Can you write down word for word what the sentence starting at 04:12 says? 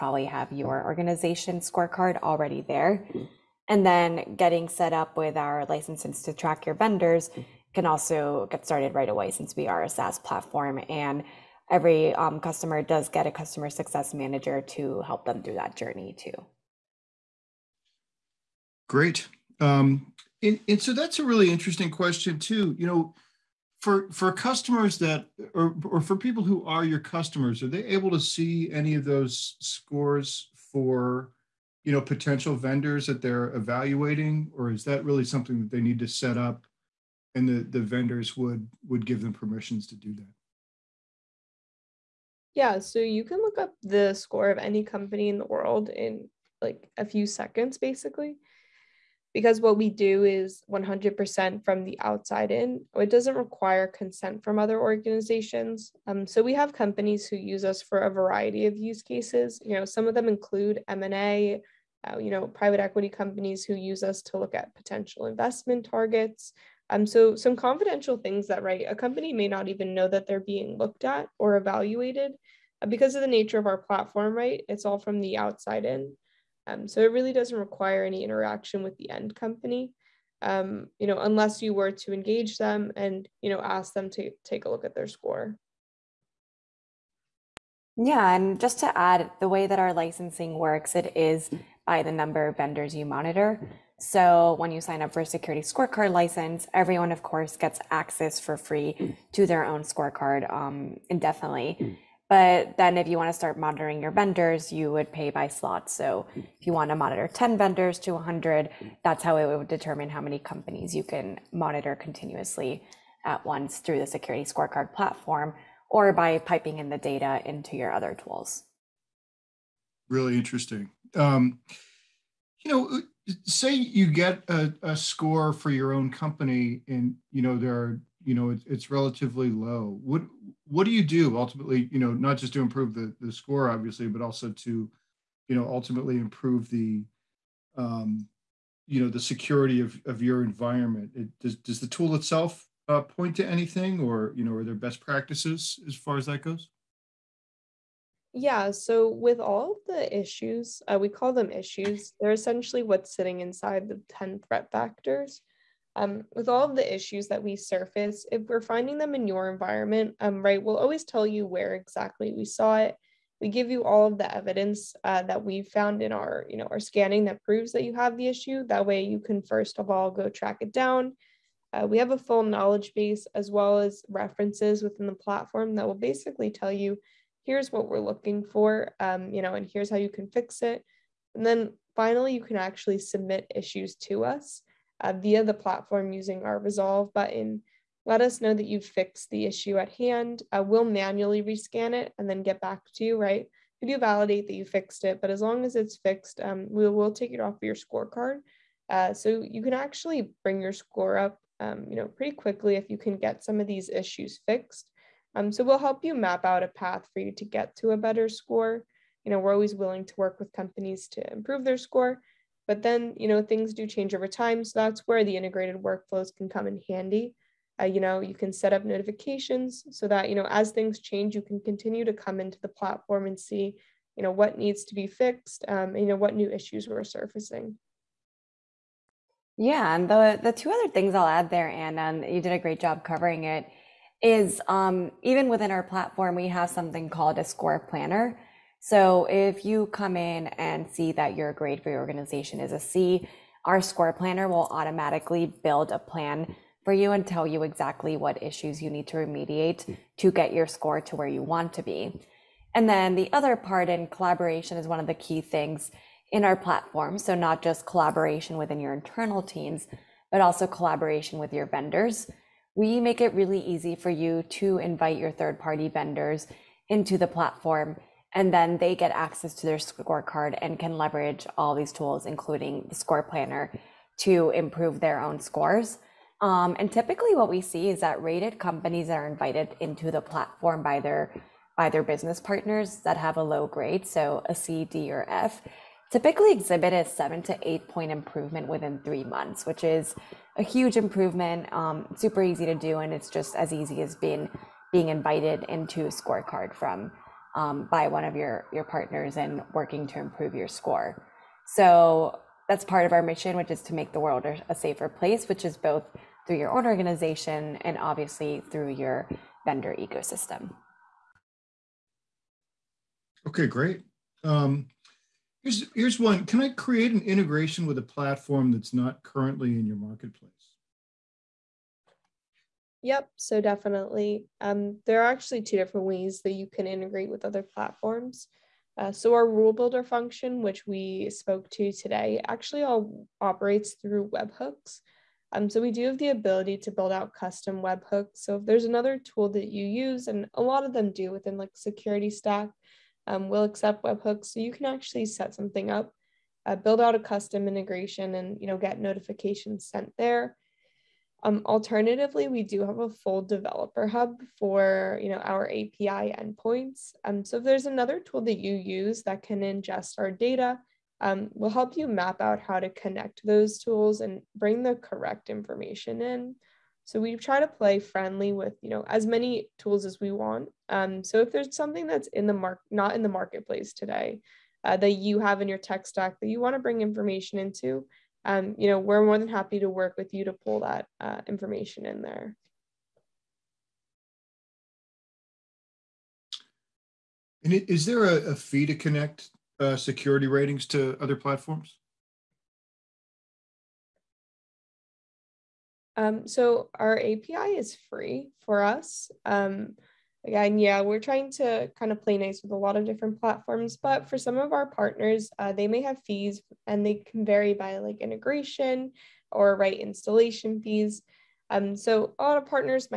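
And then the other part in collaboration is one of the key things in our platform.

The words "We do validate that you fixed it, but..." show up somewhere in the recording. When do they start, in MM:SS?
03:13.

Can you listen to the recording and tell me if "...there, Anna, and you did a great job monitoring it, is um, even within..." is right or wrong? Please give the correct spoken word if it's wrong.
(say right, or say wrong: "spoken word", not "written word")
wrong: "covering", not "monitoring".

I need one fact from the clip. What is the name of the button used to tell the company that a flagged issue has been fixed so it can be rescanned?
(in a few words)
Resolve button.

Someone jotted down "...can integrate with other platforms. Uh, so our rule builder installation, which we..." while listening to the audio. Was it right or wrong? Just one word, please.
wrong.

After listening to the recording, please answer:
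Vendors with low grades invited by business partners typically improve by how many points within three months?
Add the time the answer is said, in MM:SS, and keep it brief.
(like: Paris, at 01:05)
7 to 8 points, at 04:47.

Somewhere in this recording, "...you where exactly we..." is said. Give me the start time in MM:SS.
02:41.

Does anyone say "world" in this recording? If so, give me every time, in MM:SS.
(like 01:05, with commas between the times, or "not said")
00:45, 05:04.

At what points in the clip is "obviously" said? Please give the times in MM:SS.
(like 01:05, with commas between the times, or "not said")
02:13, 05:07.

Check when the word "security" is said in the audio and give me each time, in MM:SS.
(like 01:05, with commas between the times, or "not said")
01:35, 01:54, 02:19, 05:41, 06:29.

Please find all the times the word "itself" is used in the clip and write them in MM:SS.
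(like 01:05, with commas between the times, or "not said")
02:22.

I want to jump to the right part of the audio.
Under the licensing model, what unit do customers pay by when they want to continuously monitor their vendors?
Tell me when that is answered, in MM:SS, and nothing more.
01:45.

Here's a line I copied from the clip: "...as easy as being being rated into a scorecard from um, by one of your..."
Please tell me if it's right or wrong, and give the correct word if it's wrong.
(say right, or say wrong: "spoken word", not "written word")
wrong: "invited", not "rated".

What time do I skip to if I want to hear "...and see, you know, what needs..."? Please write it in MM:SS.
03:43.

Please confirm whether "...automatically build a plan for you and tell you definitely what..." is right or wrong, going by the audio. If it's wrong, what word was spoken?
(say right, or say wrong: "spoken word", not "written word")
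wrong: "exactly", not "definitely".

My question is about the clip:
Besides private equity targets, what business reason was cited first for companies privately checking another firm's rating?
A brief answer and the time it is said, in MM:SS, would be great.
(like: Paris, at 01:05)
M&A, at 01:00.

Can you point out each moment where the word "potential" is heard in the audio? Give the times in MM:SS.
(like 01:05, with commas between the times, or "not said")
00:32, 01:04.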